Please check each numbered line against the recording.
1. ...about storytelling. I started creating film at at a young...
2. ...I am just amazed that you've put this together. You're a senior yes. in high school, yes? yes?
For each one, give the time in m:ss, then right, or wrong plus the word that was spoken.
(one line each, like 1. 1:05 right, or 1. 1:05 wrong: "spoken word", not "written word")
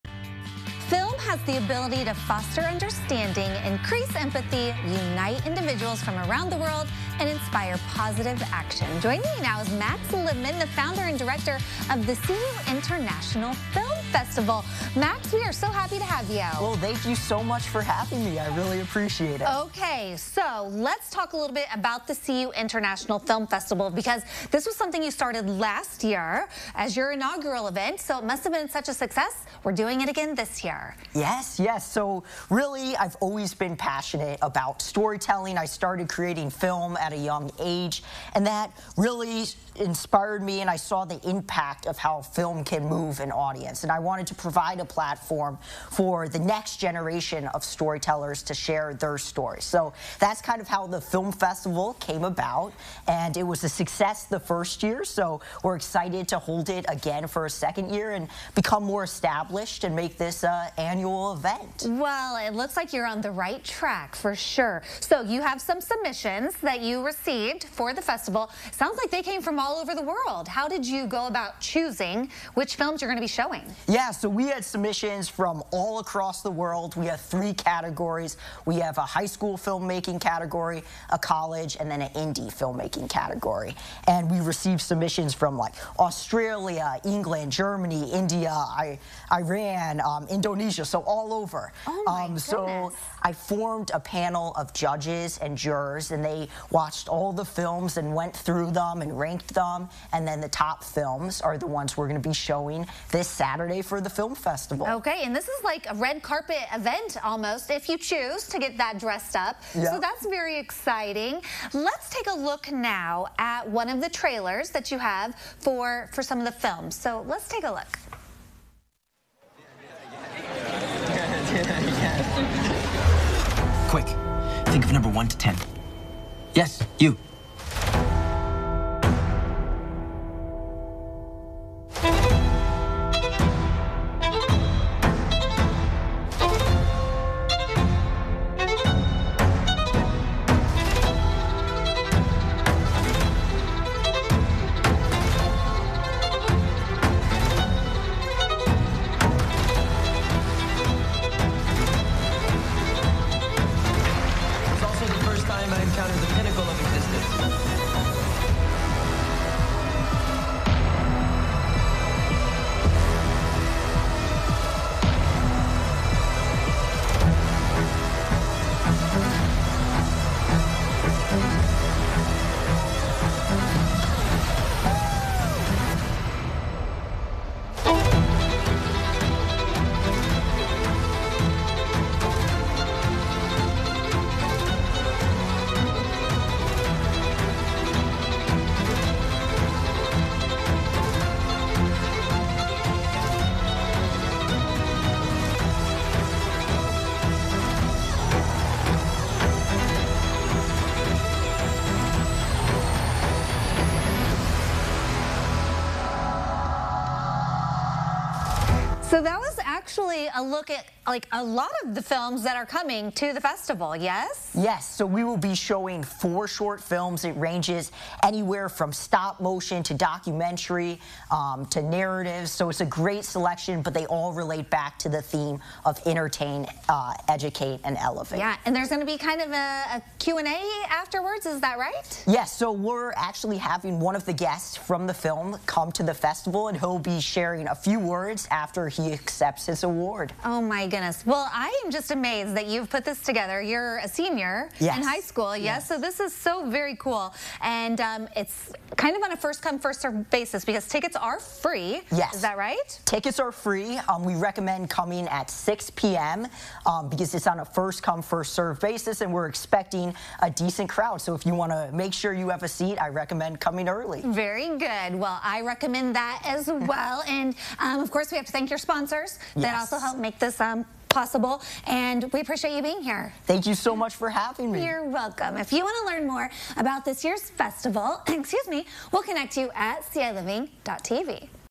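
1. 0:34 right
2. 4:01 right.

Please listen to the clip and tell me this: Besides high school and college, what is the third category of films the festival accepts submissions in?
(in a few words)
Indie filmmaking.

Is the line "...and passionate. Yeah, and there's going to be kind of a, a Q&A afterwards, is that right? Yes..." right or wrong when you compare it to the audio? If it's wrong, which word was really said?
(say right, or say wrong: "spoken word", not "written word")
wrong: "elevate", not "passionate".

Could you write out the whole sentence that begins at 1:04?
So you have some submissions that you received for the festival sounds like they came from all over the world.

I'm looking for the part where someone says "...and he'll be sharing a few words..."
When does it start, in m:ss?
3:56.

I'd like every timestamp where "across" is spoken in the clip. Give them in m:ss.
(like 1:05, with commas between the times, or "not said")
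1:15.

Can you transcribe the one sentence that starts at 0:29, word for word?
We're doing it again this year.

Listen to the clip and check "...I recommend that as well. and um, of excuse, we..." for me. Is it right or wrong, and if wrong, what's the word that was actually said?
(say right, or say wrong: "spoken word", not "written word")
wrong: "course", not "excuse".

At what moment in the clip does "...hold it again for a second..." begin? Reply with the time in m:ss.
0:56.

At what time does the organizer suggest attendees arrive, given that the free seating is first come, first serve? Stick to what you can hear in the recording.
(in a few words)
6 p.m.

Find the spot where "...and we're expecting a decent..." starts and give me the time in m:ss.
4:19.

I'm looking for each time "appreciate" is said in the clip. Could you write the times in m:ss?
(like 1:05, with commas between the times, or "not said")
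0:18, 4:32.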